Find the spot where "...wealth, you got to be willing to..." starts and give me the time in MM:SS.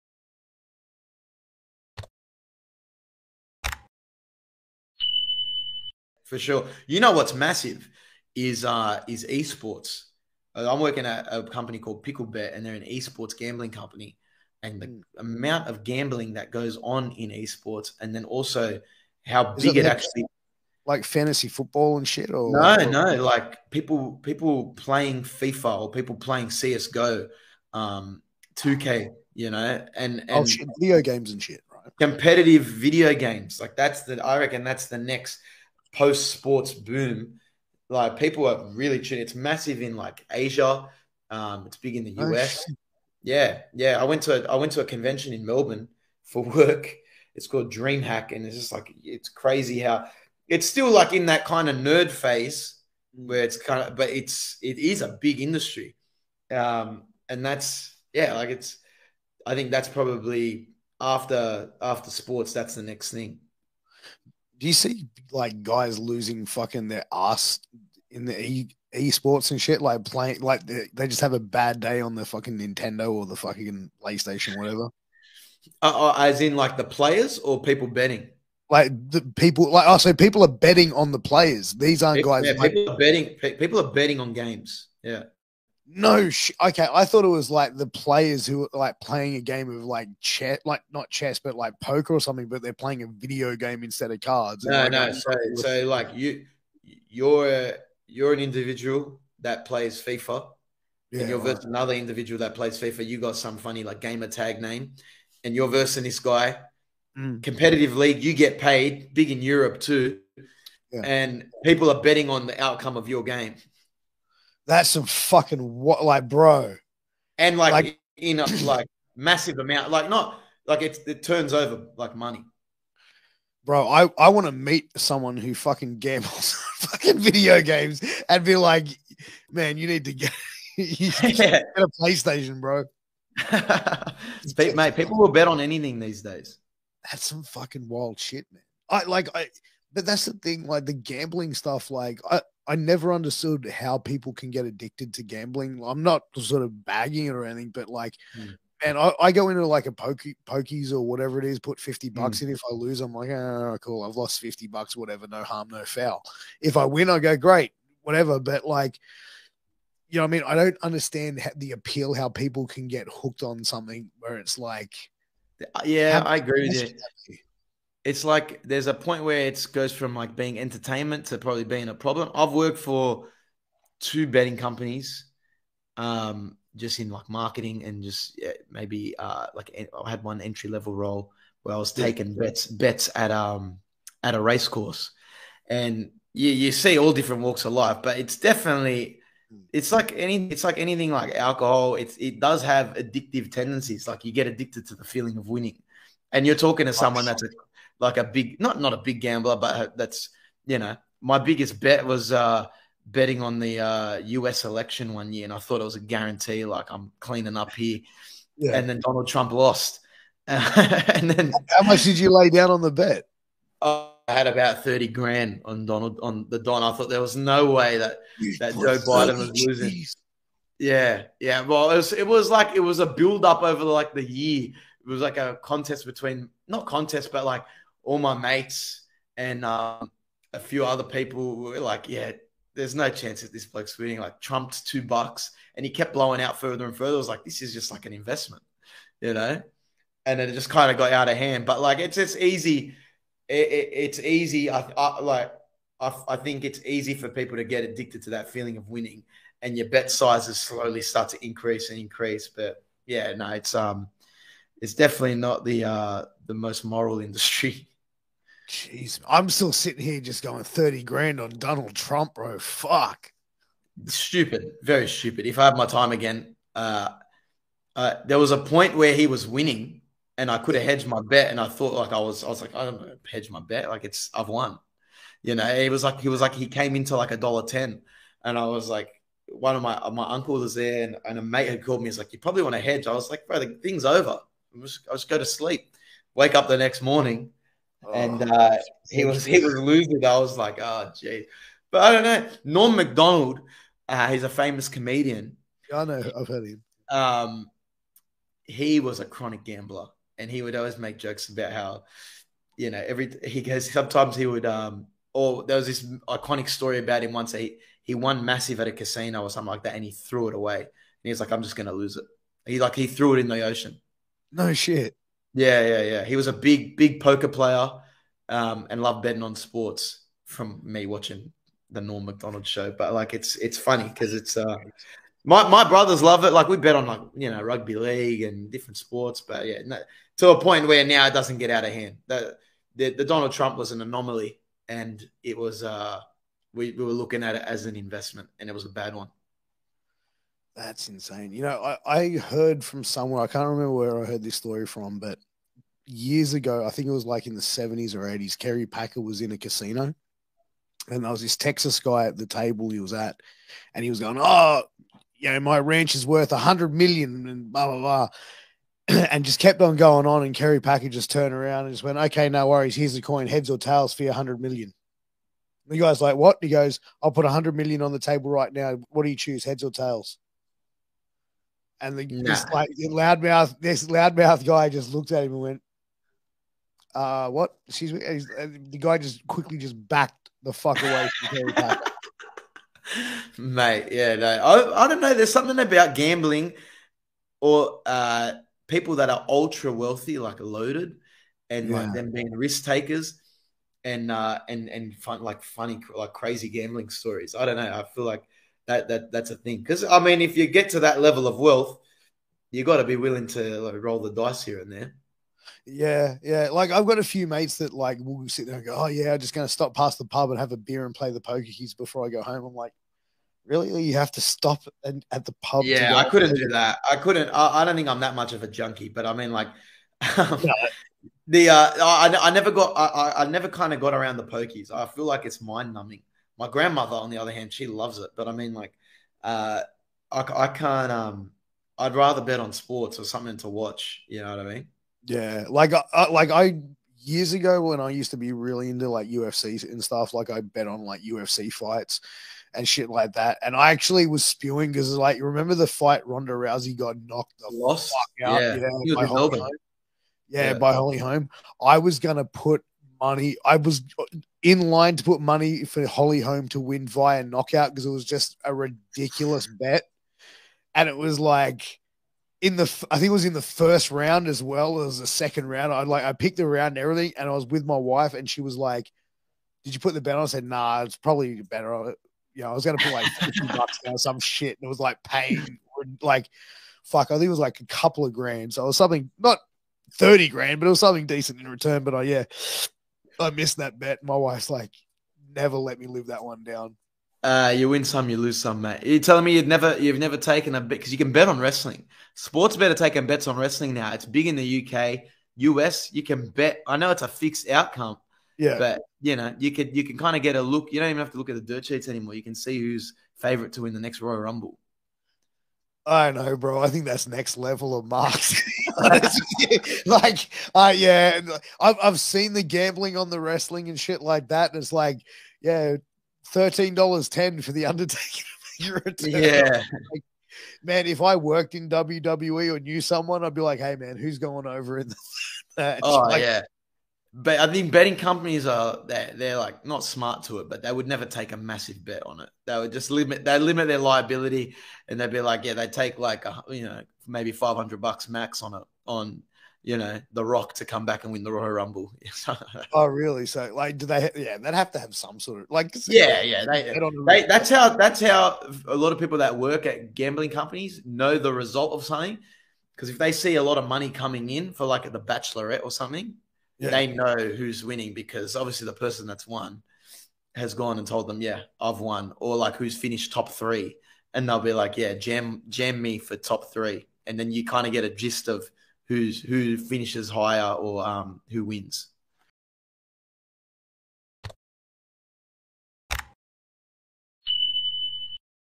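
06:41.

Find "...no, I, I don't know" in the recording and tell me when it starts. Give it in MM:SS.
06:24.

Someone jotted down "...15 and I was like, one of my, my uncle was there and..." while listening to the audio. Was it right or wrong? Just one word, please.
wrong.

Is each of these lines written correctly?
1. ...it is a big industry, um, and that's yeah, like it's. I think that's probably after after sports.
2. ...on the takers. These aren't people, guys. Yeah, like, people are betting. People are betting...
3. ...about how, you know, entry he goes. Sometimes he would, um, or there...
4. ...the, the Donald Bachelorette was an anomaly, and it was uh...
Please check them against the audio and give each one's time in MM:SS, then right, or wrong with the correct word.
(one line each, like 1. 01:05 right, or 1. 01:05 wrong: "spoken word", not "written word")
1. 00:54 right
2. 01:20 wrong: "players", not "takers"
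3. 05:01 wrong: "every", not "entry"
4. 05:32 wrong: "Trump", not "Bachelorette".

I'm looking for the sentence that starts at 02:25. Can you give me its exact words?
I'm not sort of bagging it or anything, but like, mm.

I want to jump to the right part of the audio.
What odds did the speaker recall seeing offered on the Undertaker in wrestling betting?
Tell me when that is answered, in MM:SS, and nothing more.
08:36.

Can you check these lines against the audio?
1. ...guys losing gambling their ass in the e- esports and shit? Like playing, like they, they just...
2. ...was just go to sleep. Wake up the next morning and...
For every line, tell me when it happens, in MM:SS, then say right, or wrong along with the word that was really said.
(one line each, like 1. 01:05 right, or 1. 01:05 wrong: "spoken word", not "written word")
1. 01:05 wrong: "fucking", not "gambling"
2. 04:44 right.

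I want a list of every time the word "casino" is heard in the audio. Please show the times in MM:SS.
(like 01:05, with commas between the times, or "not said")
05:08, 05:49.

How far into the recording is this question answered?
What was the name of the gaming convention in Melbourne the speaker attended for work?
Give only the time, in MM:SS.
00:47.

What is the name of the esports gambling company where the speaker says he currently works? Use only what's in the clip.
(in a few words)
Picklebet.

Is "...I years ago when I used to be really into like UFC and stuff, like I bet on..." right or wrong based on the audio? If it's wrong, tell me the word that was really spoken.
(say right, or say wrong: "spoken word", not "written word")
right.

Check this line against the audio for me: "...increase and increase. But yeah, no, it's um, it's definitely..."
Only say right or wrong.
right.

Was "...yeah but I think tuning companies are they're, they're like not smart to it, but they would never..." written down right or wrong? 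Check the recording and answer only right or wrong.
wrong.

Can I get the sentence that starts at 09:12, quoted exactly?
Because if they see a lot of money coming in for like the Bachelorette or something, yeah.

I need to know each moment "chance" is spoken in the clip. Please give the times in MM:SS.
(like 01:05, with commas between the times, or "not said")
03:53.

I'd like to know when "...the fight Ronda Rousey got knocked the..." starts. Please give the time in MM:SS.
07:25.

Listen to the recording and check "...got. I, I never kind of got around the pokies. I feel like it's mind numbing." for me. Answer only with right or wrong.
right.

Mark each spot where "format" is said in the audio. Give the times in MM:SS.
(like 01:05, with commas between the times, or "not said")
not said.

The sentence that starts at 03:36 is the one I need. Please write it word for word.
I thought there was no way that that Joe Biden was losing.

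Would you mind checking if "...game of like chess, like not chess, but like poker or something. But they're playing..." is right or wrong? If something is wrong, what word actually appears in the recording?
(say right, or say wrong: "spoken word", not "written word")
right.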